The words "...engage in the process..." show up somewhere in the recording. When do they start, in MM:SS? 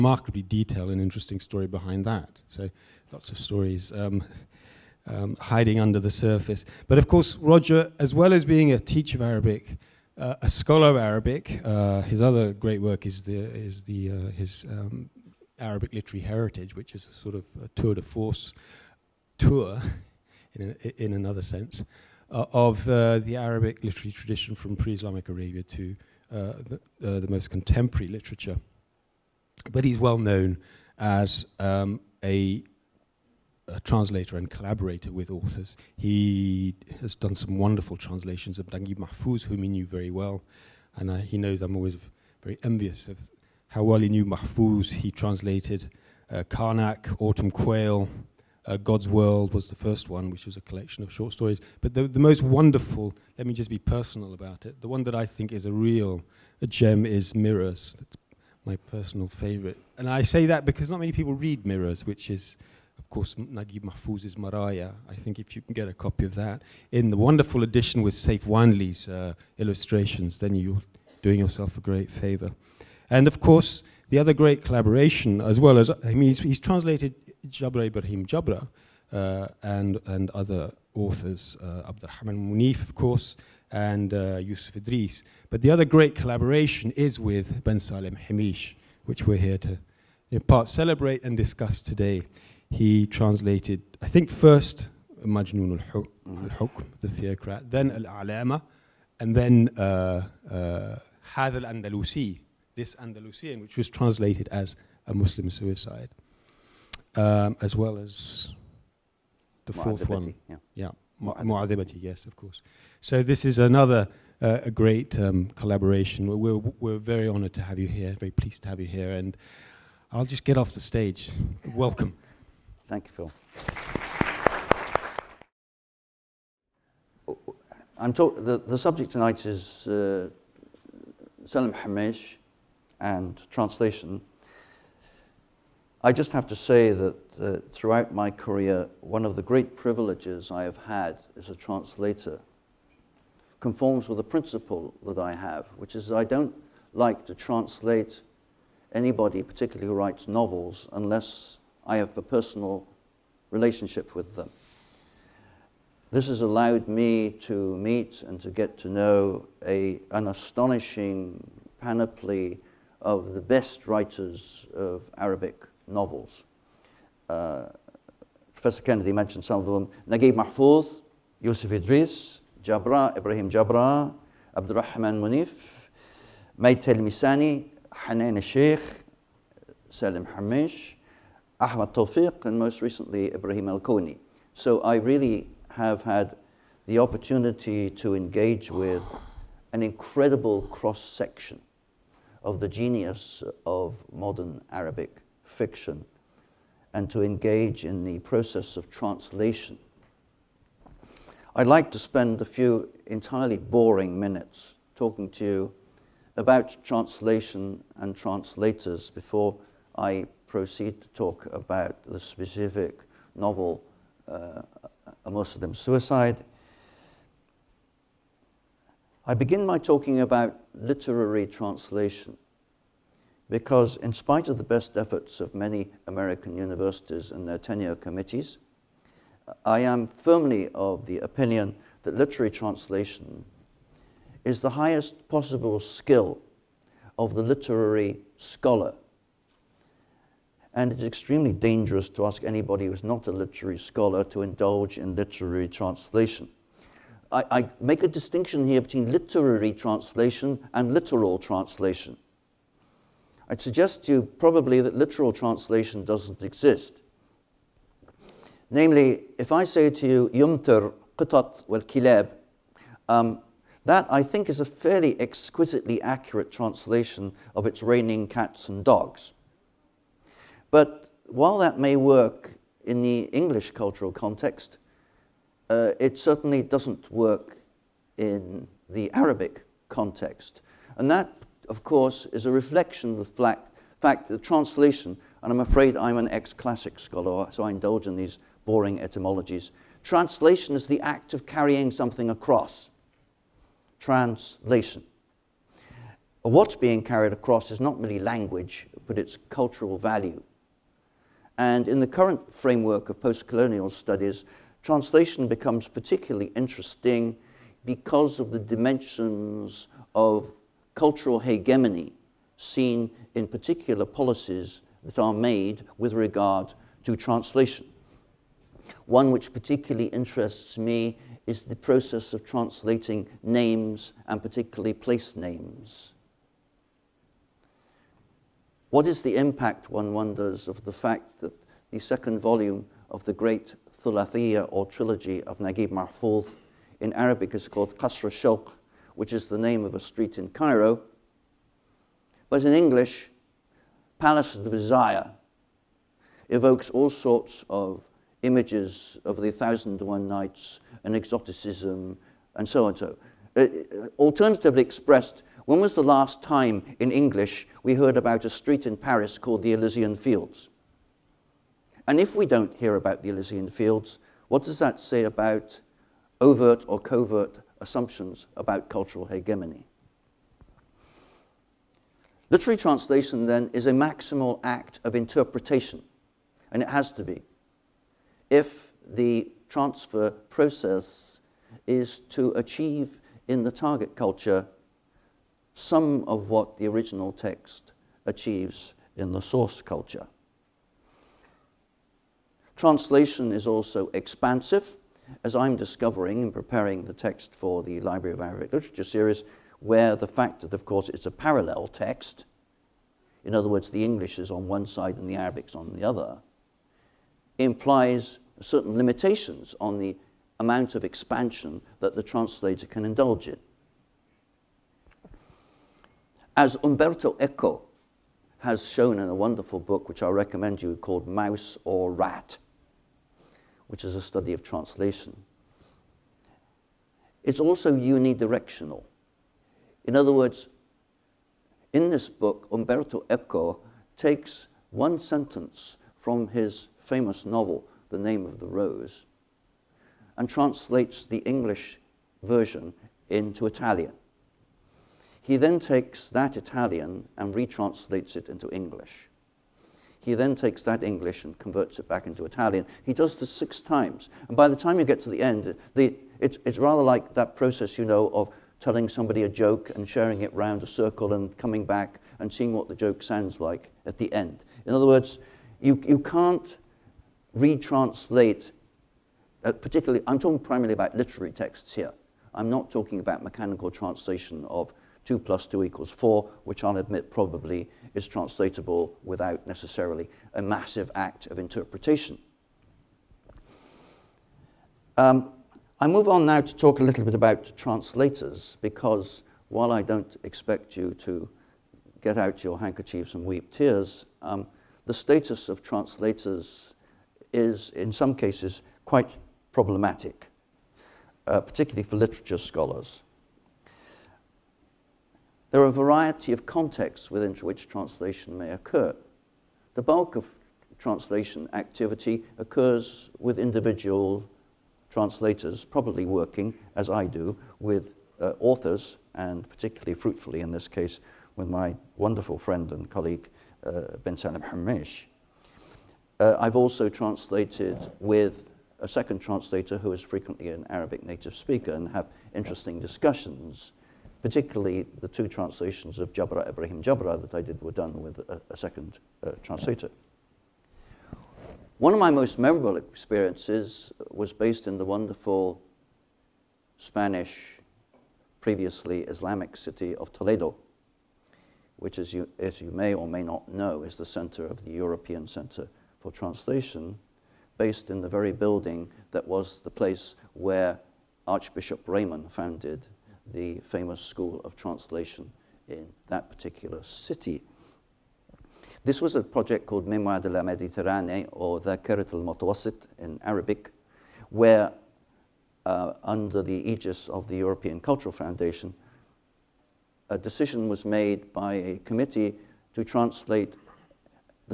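03:17.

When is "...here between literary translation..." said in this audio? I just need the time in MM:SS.
04:08.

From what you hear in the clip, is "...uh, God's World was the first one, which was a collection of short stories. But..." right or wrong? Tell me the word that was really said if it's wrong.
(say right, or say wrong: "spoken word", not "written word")
right.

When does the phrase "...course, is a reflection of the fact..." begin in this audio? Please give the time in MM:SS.
04:41.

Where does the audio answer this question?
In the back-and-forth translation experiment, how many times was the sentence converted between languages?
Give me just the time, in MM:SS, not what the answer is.
07:33.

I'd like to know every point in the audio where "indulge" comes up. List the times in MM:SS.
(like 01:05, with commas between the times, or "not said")
04:04, 04:47, 06:53.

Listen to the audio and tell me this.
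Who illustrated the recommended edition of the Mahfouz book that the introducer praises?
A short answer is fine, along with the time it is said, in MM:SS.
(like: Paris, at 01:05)
Seif Wanly, at 01:08.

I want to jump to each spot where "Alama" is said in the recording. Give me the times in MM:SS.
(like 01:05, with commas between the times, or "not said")
01:38.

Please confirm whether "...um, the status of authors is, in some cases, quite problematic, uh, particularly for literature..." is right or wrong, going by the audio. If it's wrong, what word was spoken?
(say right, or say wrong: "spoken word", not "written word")
wrong: "translators", not "authors".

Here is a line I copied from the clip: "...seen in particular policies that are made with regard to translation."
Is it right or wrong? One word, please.
right.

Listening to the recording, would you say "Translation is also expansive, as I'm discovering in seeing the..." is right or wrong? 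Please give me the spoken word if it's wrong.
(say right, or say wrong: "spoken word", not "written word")
wrong: "preparing", not "seeing".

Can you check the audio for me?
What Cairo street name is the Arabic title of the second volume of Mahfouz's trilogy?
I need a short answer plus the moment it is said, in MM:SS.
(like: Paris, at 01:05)
Qasr Shawq, at 05:37.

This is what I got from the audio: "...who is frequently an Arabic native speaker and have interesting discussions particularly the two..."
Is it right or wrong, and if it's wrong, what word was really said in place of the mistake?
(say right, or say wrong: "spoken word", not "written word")
right.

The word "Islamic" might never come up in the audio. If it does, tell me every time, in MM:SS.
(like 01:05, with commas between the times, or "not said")
00:24, 09:09.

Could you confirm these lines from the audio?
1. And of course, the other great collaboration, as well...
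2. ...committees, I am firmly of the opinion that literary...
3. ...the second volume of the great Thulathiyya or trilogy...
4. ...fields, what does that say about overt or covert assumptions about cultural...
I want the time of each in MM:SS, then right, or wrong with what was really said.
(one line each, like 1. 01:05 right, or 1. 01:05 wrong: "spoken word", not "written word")
1. 01:13 right
2. 03:47 right
3. 05:31 right
4. 06:03 right.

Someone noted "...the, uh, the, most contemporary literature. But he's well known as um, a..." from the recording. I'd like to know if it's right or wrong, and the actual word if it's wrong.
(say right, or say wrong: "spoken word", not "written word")
right.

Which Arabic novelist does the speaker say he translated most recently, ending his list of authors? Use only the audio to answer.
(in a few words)
Ibrahim Al Koni.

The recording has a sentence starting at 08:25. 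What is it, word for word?
There are a variety of contexts within which translation may occur.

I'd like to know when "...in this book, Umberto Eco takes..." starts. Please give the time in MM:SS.
07:11.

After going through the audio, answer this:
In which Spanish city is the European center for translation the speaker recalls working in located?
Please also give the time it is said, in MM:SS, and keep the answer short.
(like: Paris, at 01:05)
Toledo, at 09:10.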